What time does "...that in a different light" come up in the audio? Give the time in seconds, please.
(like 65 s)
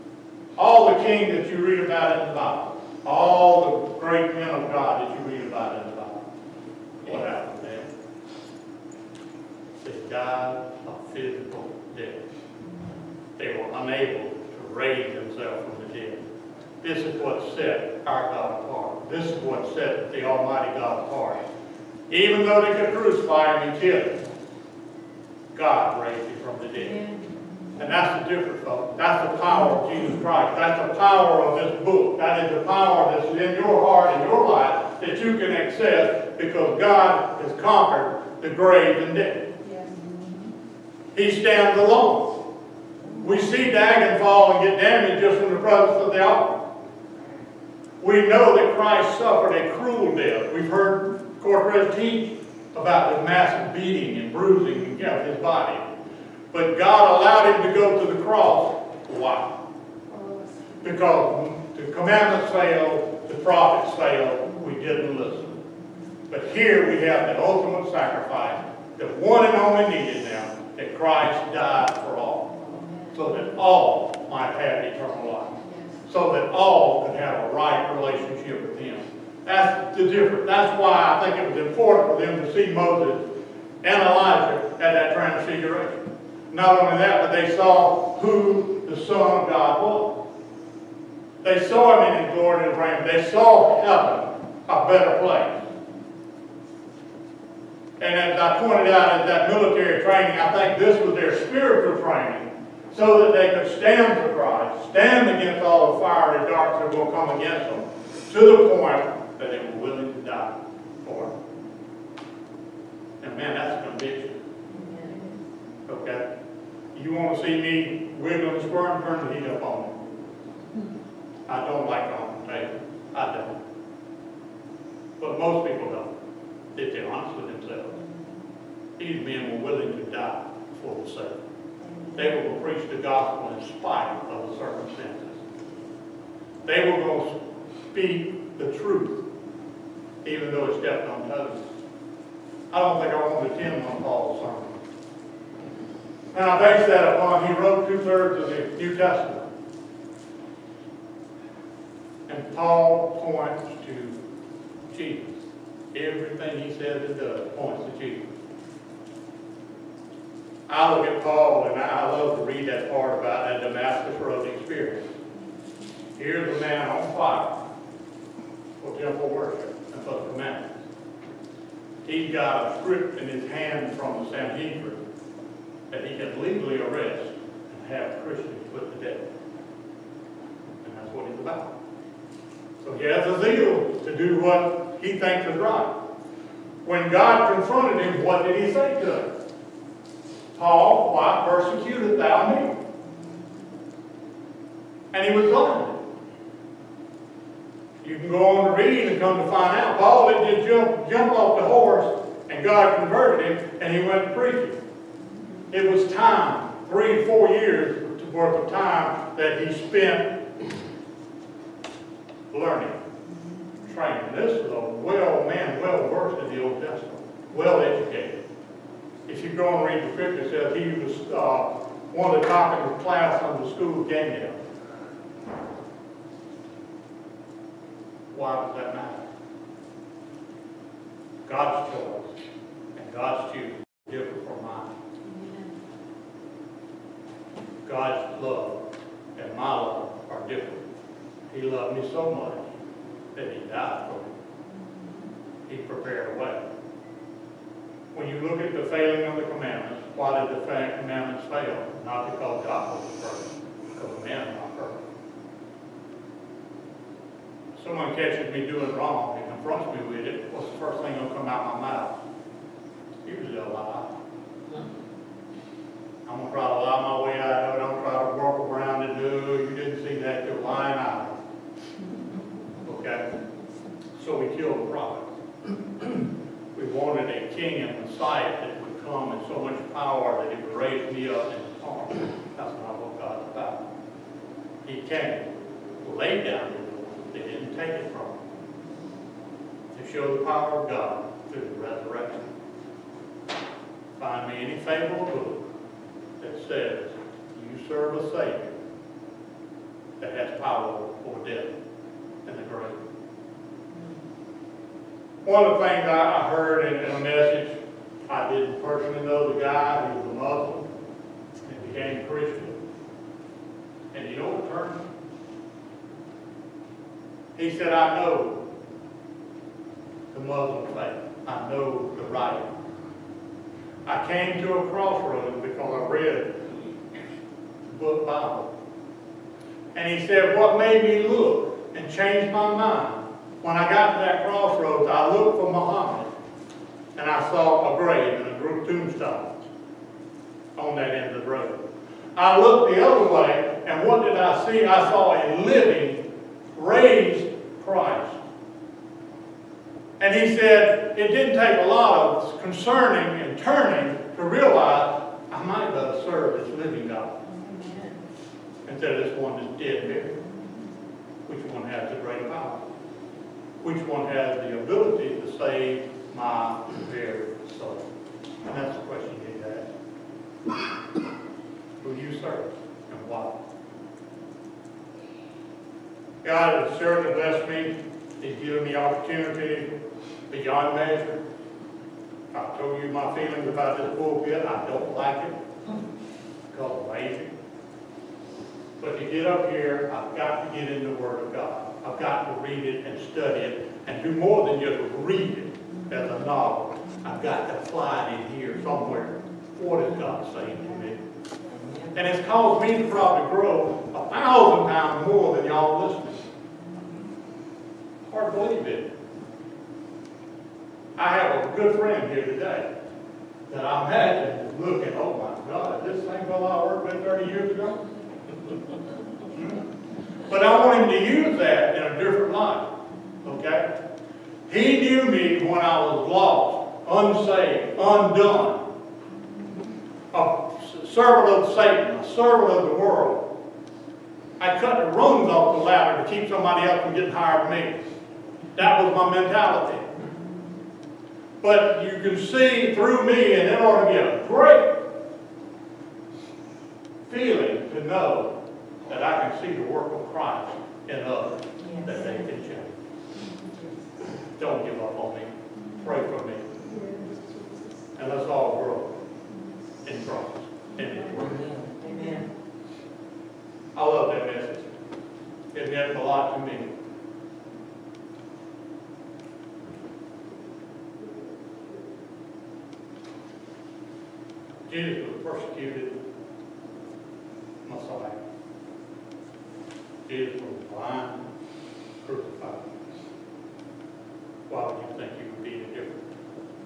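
421 s.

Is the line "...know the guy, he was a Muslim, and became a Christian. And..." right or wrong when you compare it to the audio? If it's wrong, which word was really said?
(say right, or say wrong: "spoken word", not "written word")
right.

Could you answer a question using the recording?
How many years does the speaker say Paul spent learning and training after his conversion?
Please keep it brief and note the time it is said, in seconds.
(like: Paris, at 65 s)
3 or 4 years, at 206 s.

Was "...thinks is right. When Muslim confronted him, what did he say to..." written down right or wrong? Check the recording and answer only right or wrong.
wrong.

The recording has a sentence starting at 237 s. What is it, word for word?
God's love and my love are different.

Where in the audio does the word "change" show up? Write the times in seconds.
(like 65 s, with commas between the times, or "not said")
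332 s, 452 s.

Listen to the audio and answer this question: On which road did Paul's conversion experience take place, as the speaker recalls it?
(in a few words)
Damascus Road.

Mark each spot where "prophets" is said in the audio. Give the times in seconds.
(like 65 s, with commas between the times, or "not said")
63 s, 274 s.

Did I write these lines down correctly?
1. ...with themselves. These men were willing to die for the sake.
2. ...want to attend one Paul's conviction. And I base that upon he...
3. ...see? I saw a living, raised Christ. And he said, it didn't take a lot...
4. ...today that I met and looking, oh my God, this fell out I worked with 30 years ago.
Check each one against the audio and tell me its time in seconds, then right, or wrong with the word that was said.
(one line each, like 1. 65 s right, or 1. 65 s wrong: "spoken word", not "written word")
1. 127 s right
2. 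143 s wrong: "sermon", not "conviction"
3. 344 s right
4. 412 s right.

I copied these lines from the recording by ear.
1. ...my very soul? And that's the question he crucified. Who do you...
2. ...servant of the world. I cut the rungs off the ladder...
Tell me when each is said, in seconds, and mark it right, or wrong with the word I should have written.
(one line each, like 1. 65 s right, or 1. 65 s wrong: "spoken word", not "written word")
1. 366 s wrong: "asked", not "crucified"
2. 432 s right.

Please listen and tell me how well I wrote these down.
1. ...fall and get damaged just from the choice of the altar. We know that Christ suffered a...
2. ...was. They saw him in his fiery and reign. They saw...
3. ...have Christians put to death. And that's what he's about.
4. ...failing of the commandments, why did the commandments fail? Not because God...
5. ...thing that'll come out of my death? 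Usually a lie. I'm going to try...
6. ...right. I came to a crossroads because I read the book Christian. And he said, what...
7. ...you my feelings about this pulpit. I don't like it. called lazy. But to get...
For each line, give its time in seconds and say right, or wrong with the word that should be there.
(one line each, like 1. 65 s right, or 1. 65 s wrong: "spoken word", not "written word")
1. 44 s wrong: "presence", not "choice"
2. 89 s wrong: "glory", not "fiery"
3. 177 s right
4. 248 s right
5. 261 s wrong: "mouth", not "death"
6. 322 s wrong: "Bible", not "Christian"
7. 383 s right.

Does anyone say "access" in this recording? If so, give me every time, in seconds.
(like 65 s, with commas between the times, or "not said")
35 s.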